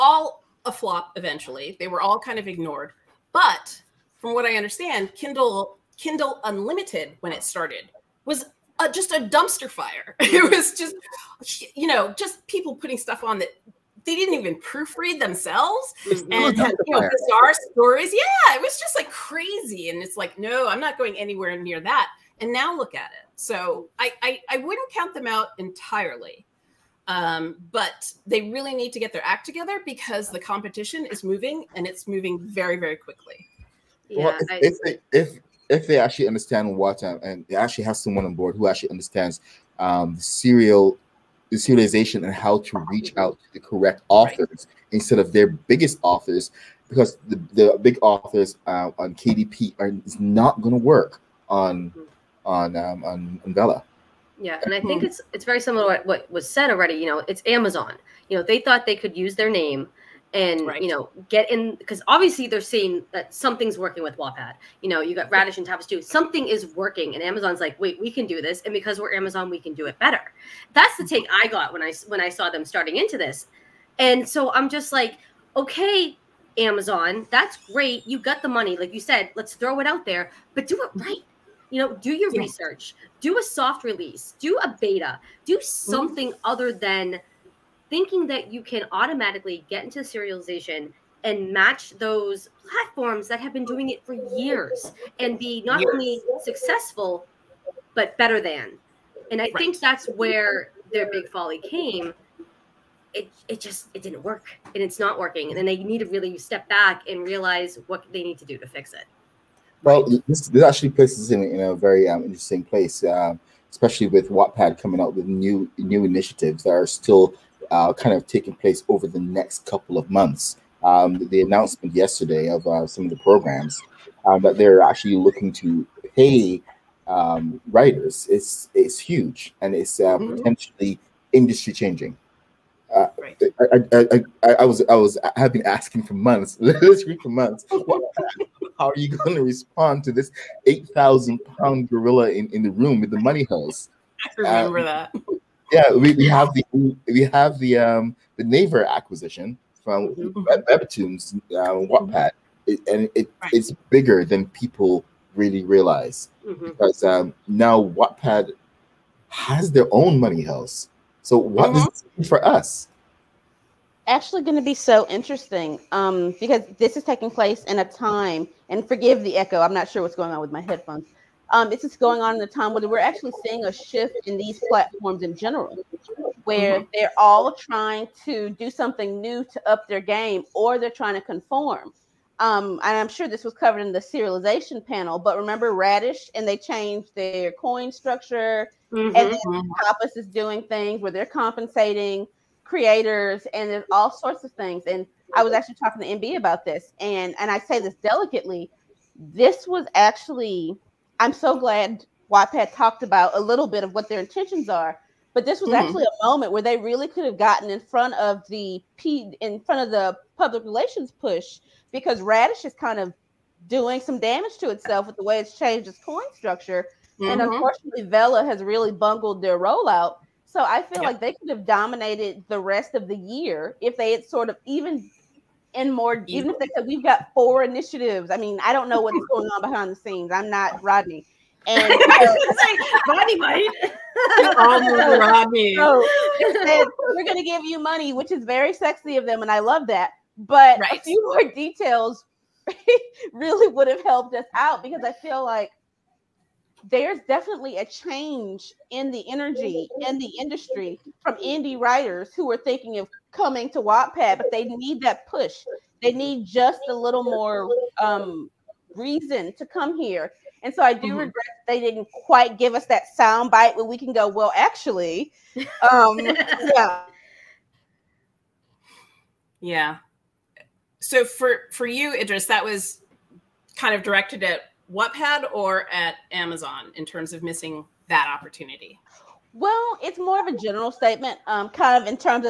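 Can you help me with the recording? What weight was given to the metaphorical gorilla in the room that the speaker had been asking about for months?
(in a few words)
8,000 pounds.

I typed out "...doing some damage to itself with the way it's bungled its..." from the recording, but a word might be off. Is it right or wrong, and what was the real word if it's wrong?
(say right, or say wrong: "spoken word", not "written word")
wrong: "changed", not "bungled".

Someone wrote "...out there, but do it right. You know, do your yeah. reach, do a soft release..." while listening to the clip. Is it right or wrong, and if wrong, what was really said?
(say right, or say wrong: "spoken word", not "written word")
wrong: "research", not "reach".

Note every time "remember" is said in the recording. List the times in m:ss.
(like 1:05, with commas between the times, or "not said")
2:24, 3:05.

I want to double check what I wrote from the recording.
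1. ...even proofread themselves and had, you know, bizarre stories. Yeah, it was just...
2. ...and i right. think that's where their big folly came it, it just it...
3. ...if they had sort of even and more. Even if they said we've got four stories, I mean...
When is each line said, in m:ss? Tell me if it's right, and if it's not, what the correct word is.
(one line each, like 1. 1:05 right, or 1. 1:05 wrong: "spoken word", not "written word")
1. 0:14 right
2. 1:39 right
3. 3:43 wrong: "initiatives", not "stories".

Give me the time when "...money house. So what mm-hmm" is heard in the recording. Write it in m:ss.
2:40.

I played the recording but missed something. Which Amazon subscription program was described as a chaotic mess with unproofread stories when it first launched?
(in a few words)
Kindle Unlimited.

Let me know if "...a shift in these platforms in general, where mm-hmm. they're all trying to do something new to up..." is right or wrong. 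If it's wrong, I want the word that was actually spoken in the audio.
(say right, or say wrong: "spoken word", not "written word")
right.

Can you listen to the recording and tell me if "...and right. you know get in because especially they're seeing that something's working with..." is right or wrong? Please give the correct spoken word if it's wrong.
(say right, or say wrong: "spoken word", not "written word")
wrong: "obviously", not "especially".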